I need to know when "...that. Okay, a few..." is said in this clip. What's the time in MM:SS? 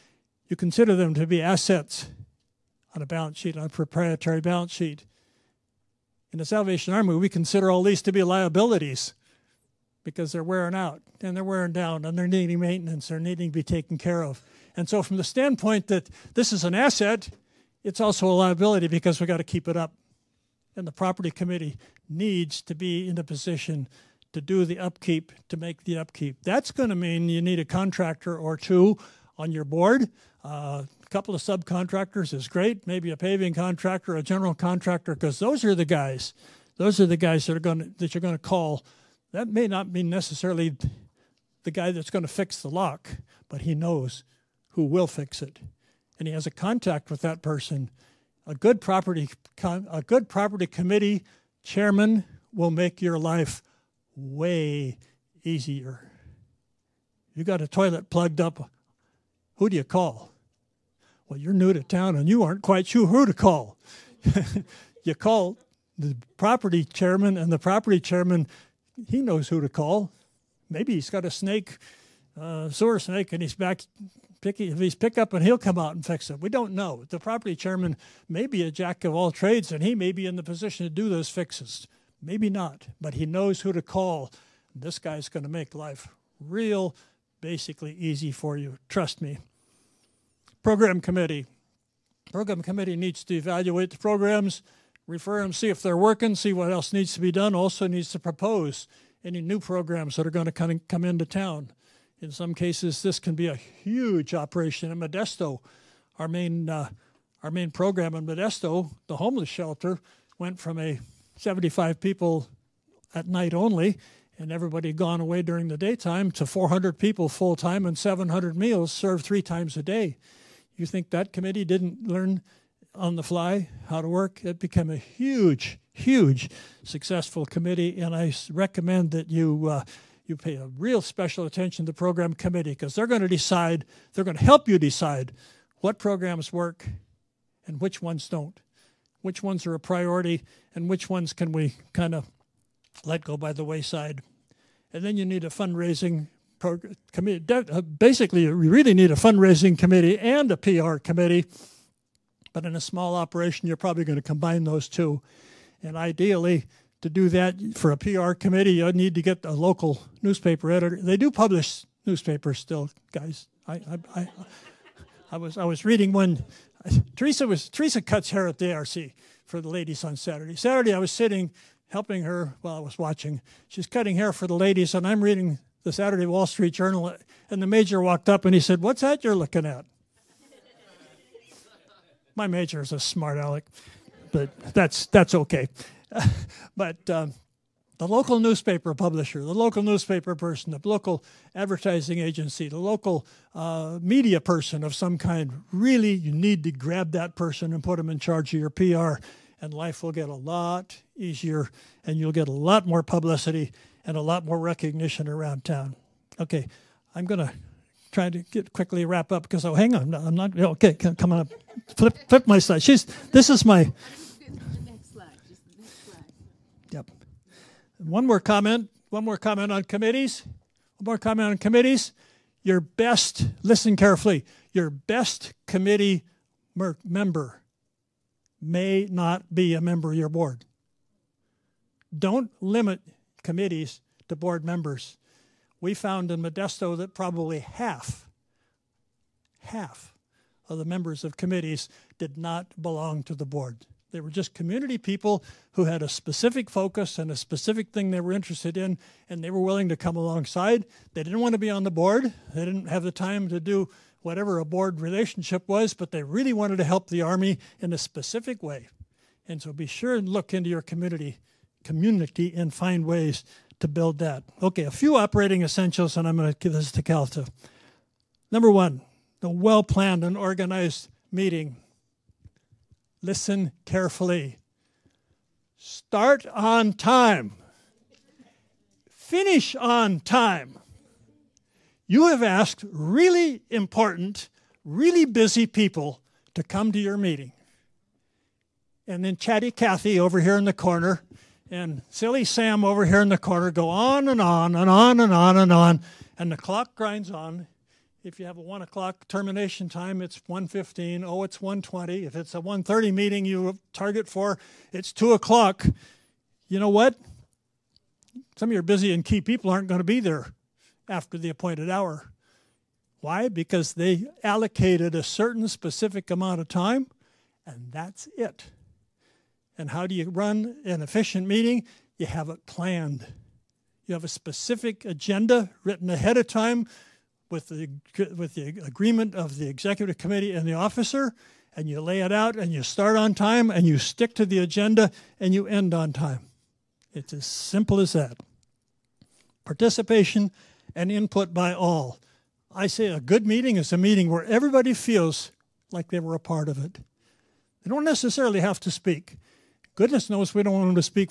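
04:24.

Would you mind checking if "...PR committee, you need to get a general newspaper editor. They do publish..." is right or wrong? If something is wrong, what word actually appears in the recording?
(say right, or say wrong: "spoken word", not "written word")
wrong: "local", not "general".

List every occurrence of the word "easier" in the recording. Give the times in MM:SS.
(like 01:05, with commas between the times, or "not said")
00:55, 03:21.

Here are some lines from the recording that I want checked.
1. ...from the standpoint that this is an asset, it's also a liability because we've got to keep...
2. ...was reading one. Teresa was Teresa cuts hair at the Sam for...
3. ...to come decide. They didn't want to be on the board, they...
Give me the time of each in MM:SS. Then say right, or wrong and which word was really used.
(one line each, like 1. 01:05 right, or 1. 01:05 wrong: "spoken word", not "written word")
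1. 00:15 right
2. 02:45 wrong: "ARC", not "Sam"
3. 04:09 wrong: "alongside", not "decide".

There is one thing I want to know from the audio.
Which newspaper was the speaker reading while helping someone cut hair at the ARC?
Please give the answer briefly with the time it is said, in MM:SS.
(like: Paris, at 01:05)
Wall Street Journal, at 02:56.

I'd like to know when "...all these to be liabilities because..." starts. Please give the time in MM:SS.
00:07.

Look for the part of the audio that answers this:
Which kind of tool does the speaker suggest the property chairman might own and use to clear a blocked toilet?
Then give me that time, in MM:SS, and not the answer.
01:12.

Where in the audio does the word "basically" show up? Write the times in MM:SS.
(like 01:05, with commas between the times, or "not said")
01:27, 02:27.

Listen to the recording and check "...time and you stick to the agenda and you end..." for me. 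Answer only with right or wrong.
right.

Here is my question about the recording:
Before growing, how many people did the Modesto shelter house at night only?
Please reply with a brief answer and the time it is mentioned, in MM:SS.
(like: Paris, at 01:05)
75, at 01:51.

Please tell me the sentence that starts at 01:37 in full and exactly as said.
Also needs to propose any new programs that are going to come, in, come into town.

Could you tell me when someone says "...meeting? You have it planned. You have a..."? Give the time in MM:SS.
05:21.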